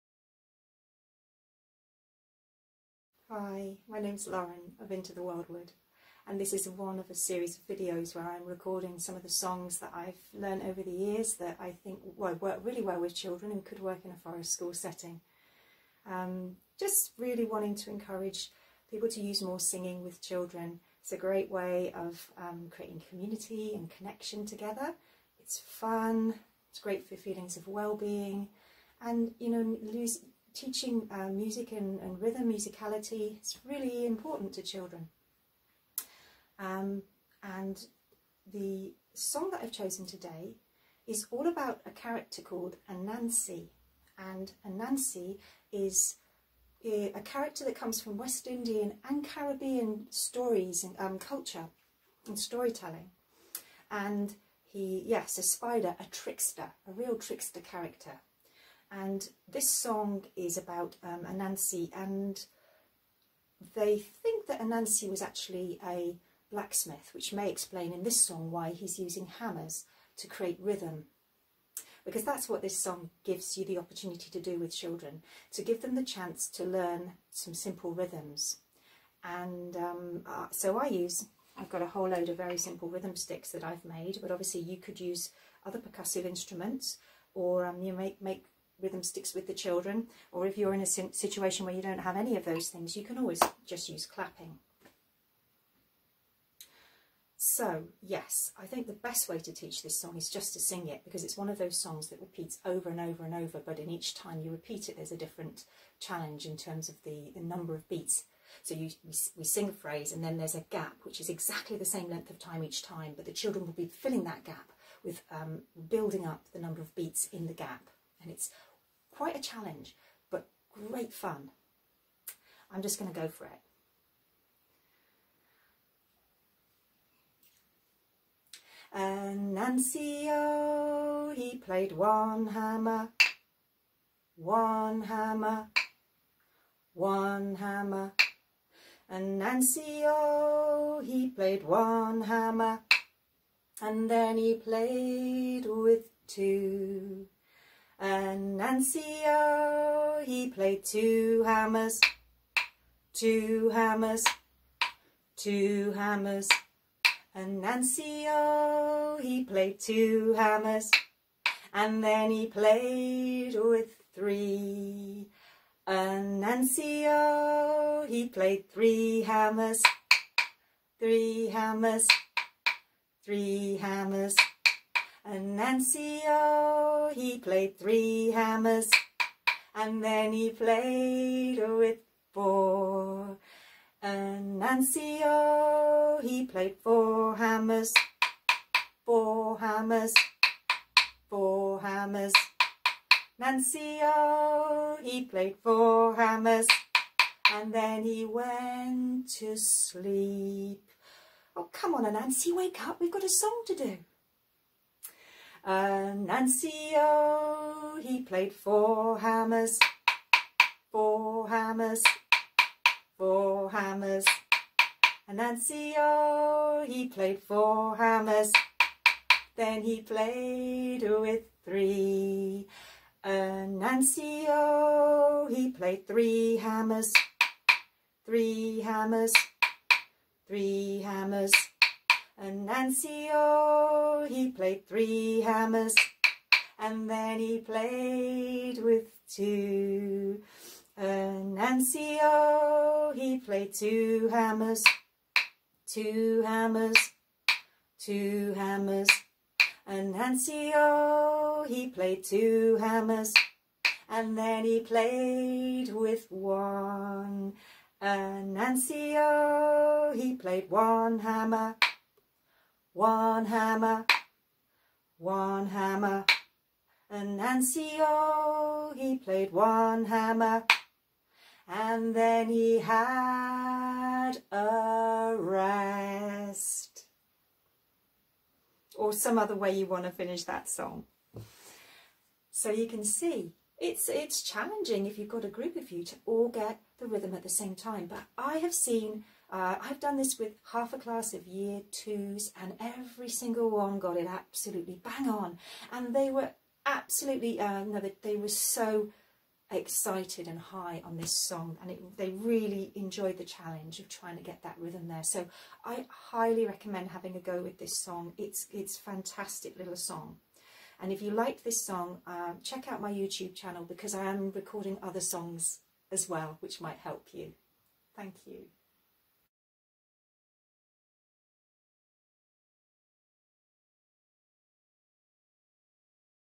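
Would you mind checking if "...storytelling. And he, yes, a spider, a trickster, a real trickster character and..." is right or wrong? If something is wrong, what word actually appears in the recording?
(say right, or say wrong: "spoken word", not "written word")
right.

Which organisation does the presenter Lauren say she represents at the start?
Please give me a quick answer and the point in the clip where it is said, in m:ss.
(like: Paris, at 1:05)
Into the Wildwood, at 0:04.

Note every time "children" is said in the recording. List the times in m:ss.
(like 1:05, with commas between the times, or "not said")
0:13, 0:20, 0:34, 1:14, 1:29, 1:53.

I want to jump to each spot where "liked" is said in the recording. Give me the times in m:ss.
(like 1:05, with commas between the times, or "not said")
5:11.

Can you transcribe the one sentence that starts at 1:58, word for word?
And it's Quite a challenge, but great fun.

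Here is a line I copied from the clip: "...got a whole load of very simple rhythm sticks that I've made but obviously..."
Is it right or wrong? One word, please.
right.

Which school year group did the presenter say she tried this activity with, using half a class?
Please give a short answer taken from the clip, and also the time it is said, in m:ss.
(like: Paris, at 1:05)
Year 2, at 4:51.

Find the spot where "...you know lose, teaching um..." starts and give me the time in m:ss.
0:29.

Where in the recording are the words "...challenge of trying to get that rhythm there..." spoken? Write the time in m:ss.
5:03.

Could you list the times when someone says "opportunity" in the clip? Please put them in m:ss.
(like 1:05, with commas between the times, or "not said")
1:13.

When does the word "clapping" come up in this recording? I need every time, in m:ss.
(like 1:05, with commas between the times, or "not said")
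1:34.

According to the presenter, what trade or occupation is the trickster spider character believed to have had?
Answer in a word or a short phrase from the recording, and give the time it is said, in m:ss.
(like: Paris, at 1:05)
blacksmith, at 1:06.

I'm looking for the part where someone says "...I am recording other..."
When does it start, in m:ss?
5:14.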